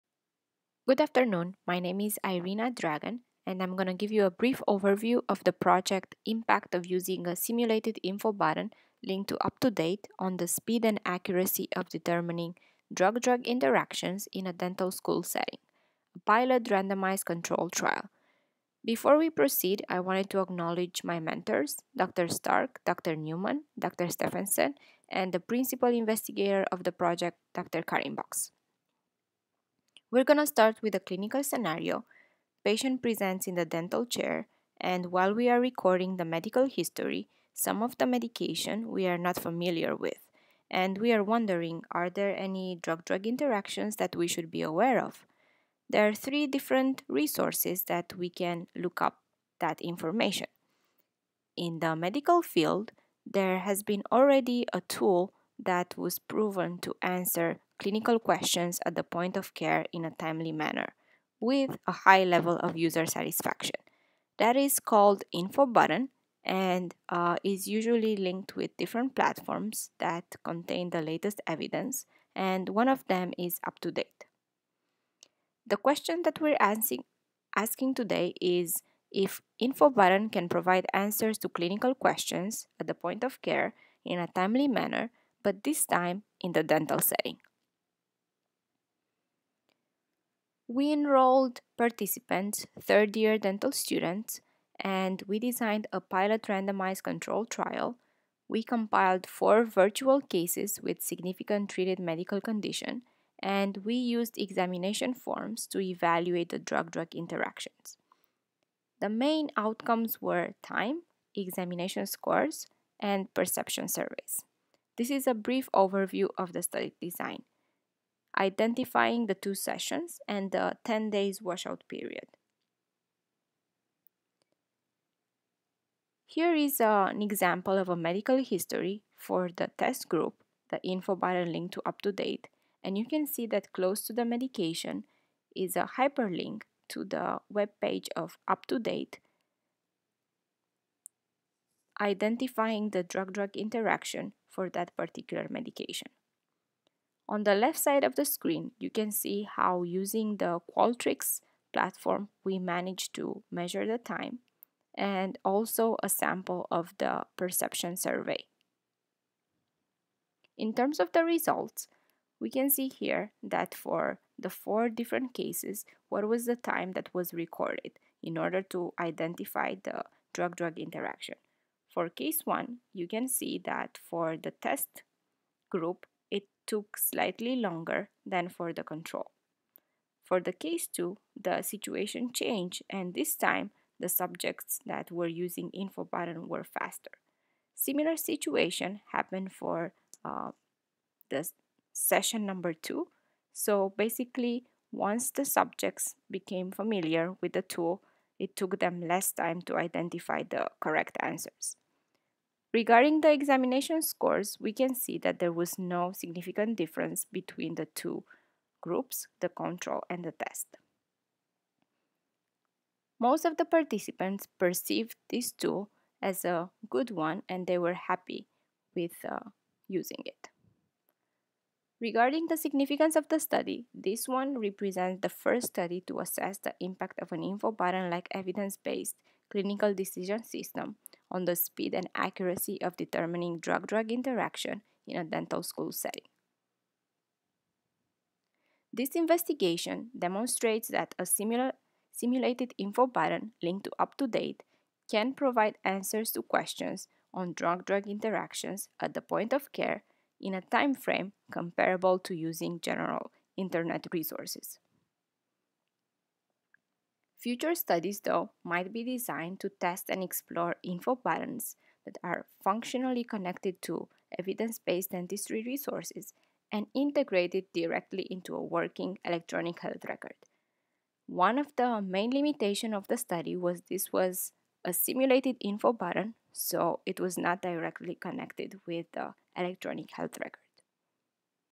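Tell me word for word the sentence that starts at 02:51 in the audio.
For case 1, you can see that for the test group, took slightly longer than for the control.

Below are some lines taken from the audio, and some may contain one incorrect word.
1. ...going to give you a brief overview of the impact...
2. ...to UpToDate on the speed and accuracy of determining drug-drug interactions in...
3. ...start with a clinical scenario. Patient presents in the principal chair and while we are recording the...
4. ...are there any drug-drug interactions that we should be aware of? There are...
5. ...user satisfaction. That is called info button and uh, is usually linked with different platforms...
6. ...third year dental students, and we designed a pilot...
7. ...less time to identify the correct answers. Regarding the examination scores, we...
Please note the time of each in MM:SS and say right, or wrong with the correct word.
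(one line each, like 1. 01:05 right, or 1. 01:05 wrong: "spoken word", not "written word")
1. 00:03 wrong: "project", not "impact"
2. 00:09 right
3. 00:30 wrong: "dental", not "principal"
4. 00:41 right
5. 01:02 right
6. 01:32 right
7. 03:19 right.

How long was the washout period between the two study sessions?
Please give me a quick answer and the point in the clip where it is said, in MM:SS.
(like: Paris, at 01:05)
10 days, at 02:00.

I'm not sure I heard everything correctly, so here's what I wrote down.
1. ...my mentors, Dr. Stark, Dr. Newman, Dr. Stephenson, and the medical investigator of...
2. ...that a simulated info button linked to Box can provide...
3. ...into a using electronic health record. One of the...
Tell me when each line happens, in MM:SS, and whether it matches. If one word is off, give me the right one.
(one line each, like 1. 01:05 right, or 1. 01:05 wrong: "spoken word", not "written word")
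1. 00:21 wrong: "principal", not "medical"
2. 04:00 wrong: "UpToDate", not "Box"
3. 04:28 wrong: "working", not "using".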